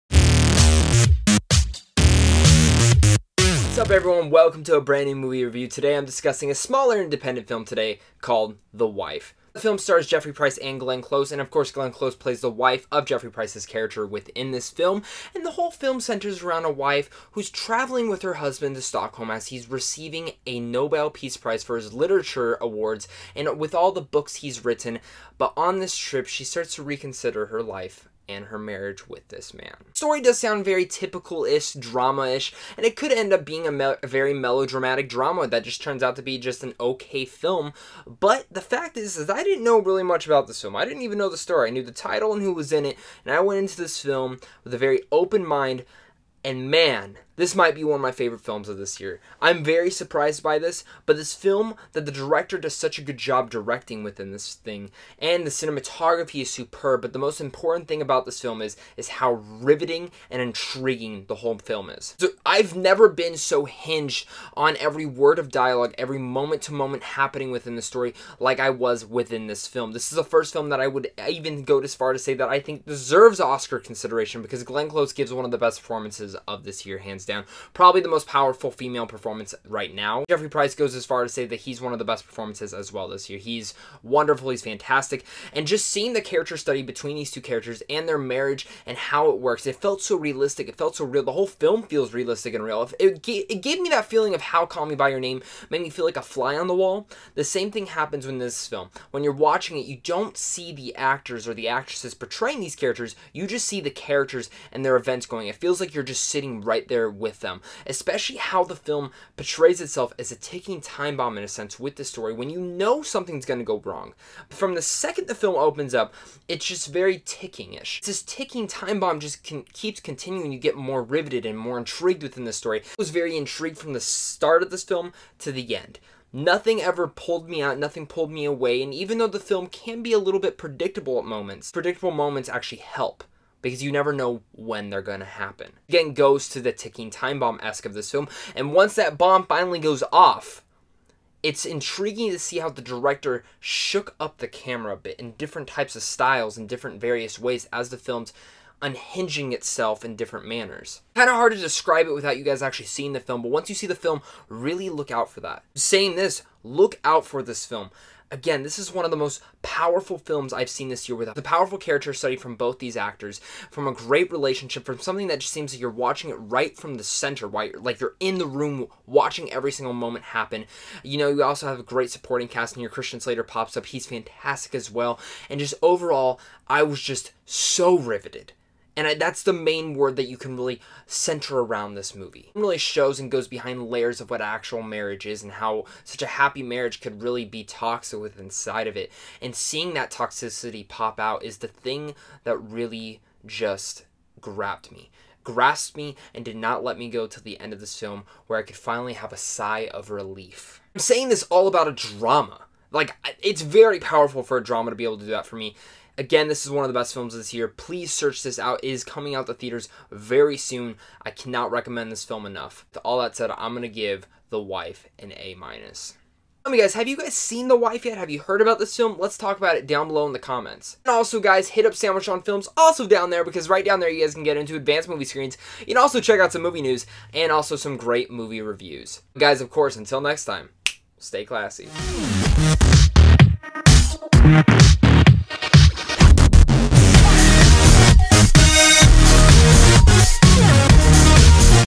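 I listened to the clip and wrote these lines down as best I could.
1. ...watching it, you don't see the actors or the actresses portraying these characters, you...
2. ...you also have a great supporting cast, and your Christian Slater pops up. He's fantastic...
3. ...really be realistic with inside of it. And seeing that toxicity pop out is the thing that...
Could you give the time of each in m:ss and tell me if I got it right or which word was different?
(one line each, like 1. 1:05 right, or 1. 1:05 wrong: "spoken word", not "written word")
1. 1:39 right
2. 2:51 right
3. 3:07 wrong: "toxic", not "realistic".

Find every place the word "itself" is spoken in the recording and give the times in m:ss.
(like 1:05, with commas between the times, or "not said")
1:49, 2:29.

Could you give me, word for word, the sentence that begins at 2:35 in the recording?
Saying this, look out for this film.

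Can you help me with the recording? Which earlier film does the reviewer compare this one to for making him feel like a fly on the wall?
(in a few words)
Call Me By Your Name.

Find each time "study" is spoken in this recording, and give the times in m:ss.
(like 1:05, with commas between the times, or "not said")
1:26, 2:42.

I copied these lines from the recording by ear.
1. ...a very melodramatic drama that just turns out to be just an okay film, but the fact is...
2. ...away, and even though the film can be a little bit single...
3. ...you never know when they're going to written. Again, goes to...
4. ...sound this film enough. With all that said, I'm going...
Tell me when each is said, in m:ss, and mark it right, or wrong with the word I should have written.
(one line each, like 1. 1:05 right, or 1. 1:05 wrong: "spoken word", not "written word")
1. 0:34 right
2. 2:08 wrong: "predictable", not "single"
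3. 2:13 wrong: "happen", not "written"
4. 3:31 wrong: "recommend", not "sound".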